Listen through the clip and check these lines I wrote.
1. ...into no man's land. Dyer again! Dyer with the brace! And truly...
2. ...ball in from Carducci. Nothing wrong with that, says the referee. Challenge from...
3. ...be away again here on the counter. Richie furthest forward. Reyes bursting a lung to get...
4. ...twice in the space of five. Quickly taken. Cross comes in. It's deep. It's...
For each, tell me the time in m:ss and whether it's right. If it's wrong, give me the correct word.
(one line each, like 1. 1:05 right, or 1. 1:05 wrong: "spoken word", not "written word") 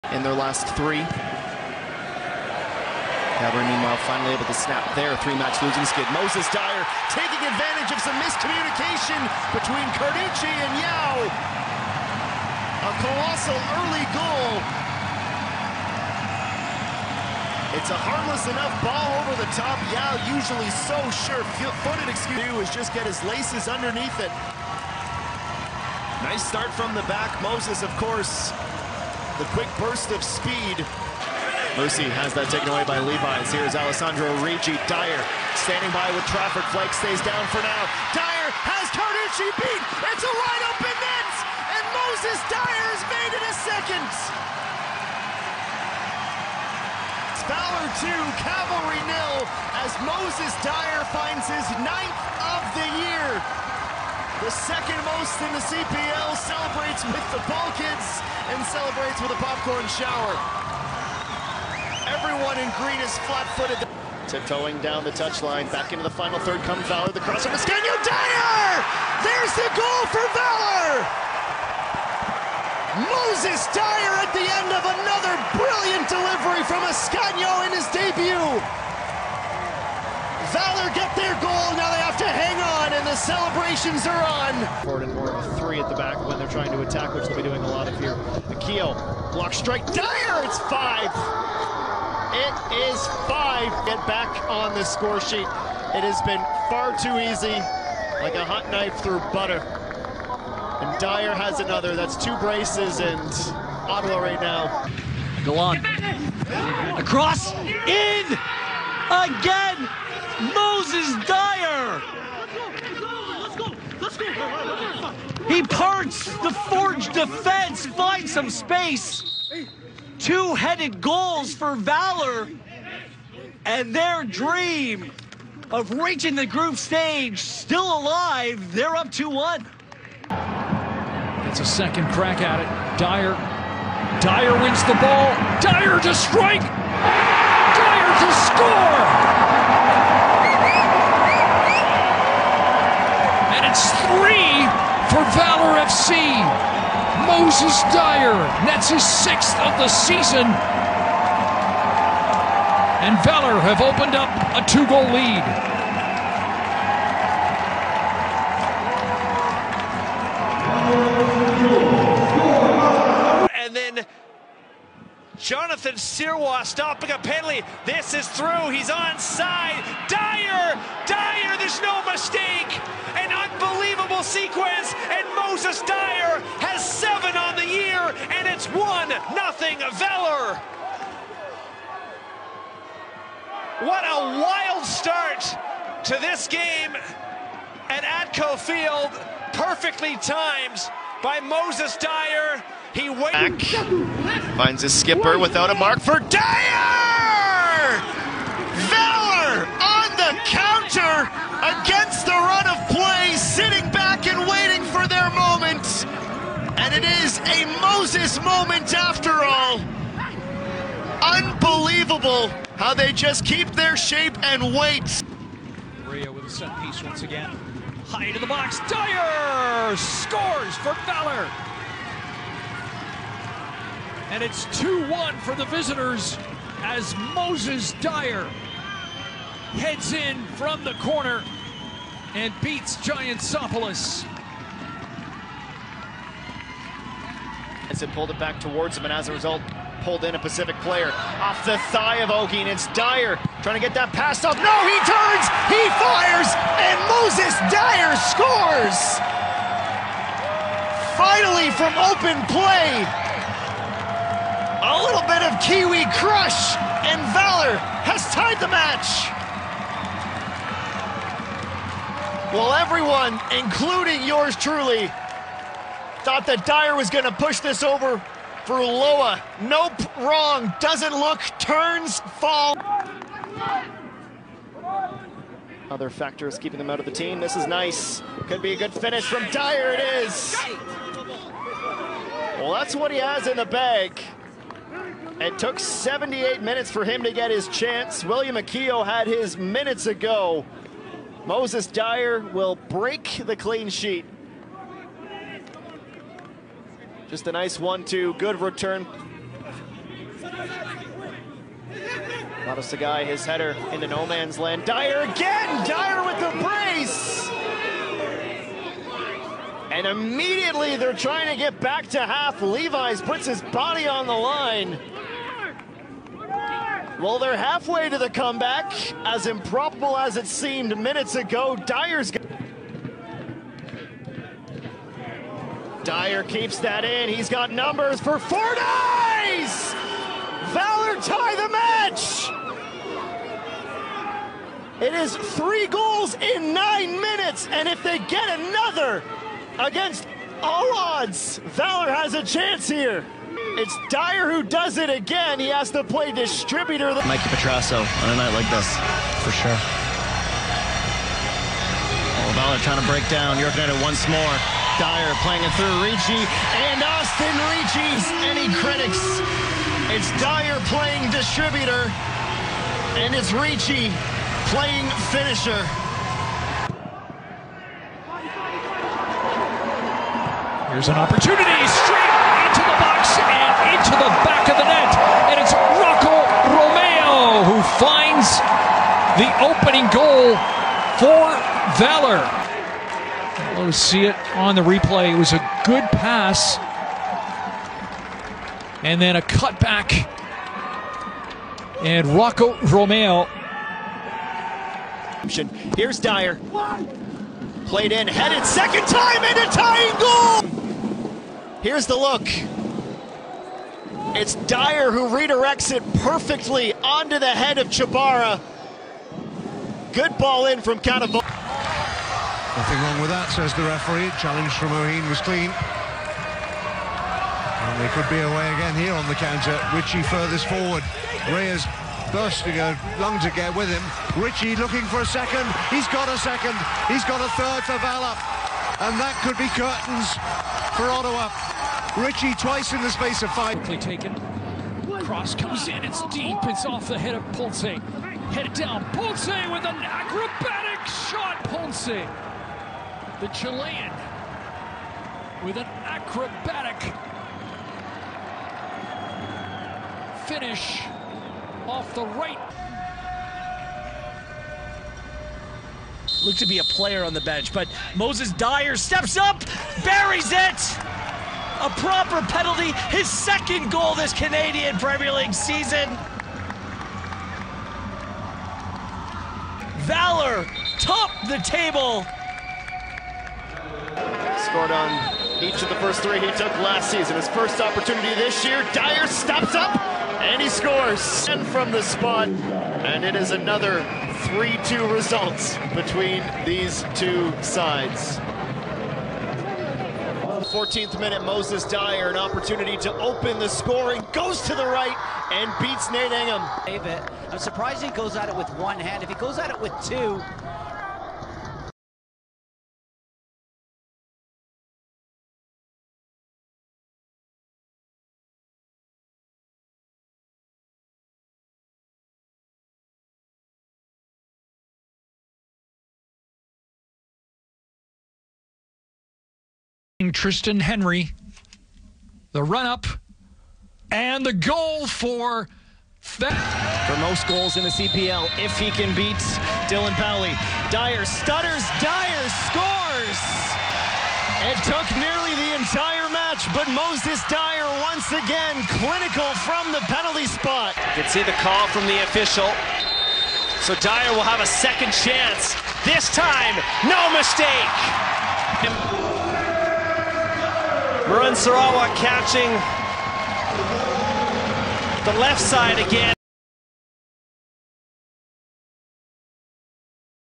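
1. 5:03 wrong: "immediately", not "truly"
2. 6:50 wrong: "Cannavale", not "Carducci"
3. 6:58 right
4. 7:12 right.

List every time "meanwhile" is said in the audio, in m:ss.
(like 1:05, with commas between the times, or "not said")
0:03.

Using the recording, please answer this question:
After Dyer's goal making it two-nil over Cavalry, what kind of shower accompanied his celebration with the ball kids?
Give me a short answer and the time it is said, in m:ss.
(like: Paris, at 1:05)
popcorn, at 0:59.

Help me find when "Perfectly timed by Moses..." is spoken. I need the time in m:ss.
3:09.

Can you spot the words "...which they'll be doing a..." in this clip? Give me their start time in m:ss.
1:27.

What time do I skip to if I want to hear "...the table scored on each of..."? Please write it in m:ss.
7:51.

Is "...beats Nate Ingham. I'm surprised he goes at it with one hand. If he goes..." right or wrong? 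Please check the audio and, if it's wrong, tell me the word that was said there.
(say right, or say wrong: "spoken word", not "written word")
right.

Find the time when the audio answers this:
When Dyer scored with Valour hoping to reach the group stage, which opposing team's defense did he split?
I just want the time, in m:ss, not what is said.
1:56.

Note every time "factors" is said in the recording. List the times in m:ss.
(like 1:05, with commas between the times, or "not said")
4:36.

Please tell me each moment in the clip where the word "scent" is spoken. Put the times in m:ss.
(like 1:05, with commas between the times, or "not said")
not said.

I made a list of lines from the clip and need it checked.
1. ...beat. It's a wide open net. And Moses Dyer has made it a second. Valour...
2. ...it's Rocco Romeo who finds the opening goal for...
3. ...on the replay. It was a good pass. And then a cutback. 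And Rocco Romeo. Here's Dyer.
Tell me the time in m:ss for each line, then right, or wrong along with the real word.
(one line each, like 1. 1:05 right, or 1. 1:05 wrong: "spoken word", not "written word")
1. 0:39 right
2. 6:15 right
3. 6:24 right.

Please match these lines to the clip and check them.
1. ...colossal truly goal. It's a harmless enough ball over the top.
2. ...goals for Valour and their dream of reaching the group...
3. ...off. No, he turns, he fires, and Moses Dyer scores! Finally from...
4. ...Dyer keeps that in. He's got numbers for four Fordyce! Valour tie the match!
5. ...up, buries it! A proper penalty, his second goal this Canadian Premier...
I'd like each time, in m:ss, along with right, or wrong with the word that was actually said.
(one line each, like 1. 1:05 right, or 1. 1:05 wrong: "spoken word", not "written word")
1. 0:13 wrong: "early", not "truly"
2. 2:01 right
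3. 4:04 right
4. 5:26 right
5. 7:39 right.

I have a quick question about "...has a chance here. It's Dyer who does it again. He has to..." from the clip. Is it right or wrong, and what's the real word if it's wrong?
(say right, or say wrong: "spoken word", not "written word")
right.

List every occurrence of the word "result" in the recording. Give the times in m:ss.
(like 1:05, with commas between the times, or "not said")
3:59, 8:05.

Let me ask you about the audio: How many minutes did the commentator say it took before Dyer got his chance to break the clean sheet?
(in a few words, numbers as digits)
78.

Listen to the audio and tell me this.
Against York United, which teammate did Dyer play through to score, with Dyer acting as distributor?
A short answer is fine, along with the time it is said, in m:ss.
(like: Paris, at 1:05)
Austin Ricci, at 5:57.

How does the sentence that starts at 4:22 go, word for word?
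Well, everyone, including yours truly, Thought that Dyer was going to push this over for Loa.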